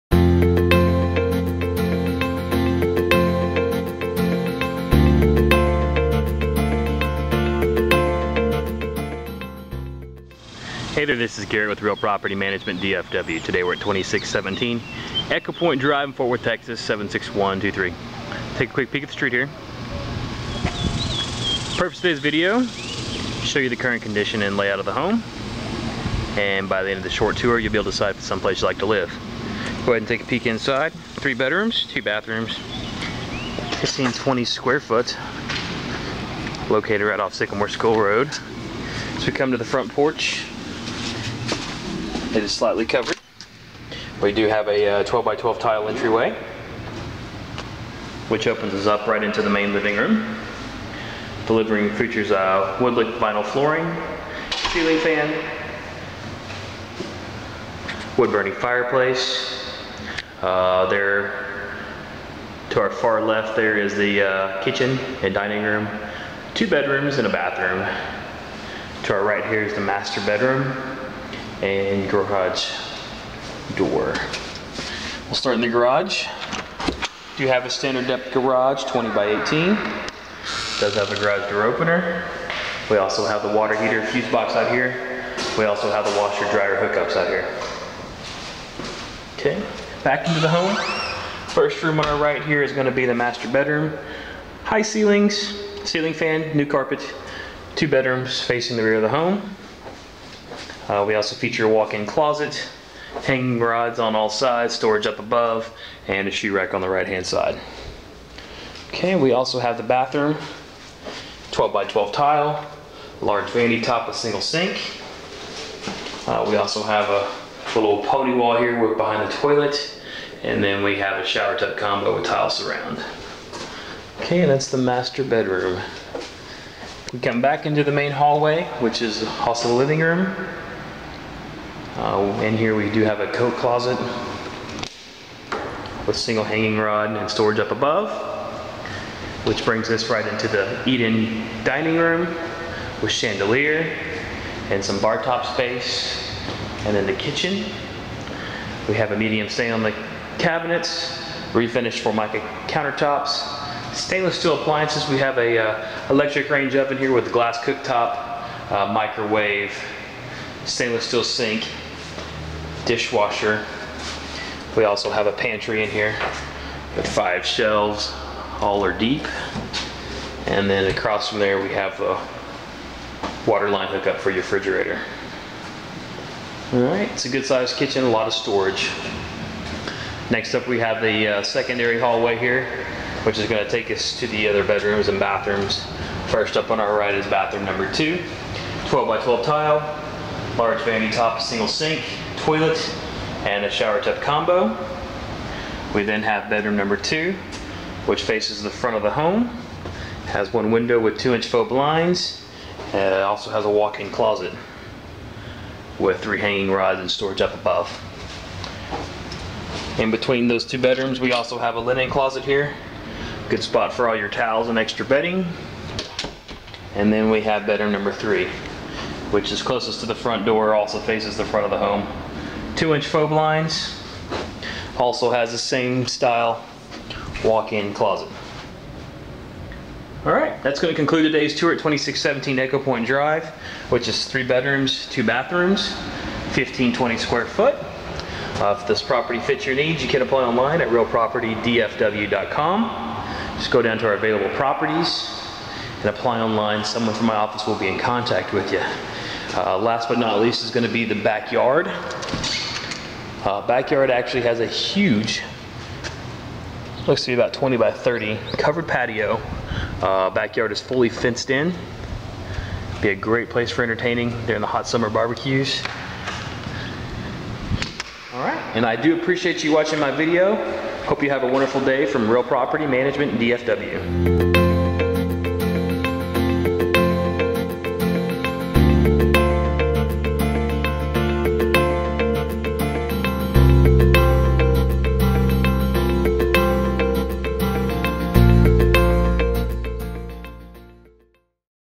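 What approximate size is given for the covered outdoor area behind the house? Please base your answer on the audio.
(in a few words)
20 by 30.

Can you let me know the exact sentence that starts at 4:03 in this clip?
Just go down to our available properties and apply online.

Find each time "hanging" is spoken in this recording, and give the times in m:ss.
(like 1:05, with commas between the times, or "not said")
1:43, 2:16, 3:26.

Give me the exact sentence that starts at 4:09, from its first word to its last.
Uh, last but not least is going to be the backyard.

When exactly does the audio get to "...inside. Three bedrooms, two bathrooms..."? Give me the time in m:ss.
0:30.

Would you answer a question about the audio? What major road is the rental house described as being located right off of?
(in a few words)
Sycamore School Road.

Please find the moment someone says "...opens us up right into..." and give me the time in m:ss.
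0:48.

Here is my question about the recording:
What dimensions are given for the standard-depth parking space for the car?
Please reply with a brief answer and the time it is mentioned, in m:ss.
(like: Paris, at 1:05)
20 by 18, at 1:18.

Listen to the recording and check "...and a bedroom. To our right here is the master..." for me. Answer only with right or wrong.
wrong.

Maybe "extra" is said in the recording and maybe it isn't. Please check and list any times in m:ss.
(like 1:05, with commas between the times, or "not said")
3:34.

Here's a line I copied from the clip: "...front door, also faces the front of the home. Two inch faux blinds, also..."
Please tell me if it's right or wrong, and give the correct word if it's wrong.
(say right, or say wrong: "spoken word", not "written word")
right.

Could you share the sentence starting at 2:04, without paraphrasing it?
Okay, and that's the master bedroom.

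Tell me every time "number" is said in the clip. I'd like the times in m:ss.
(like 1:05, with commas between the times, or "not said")
3:07, 3:16, 3:37.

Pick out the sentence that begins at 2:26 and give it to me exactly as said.
And then the kitchen, we have a medium stain on the cabinets, refinished Formica countertops, stainless steel appliances.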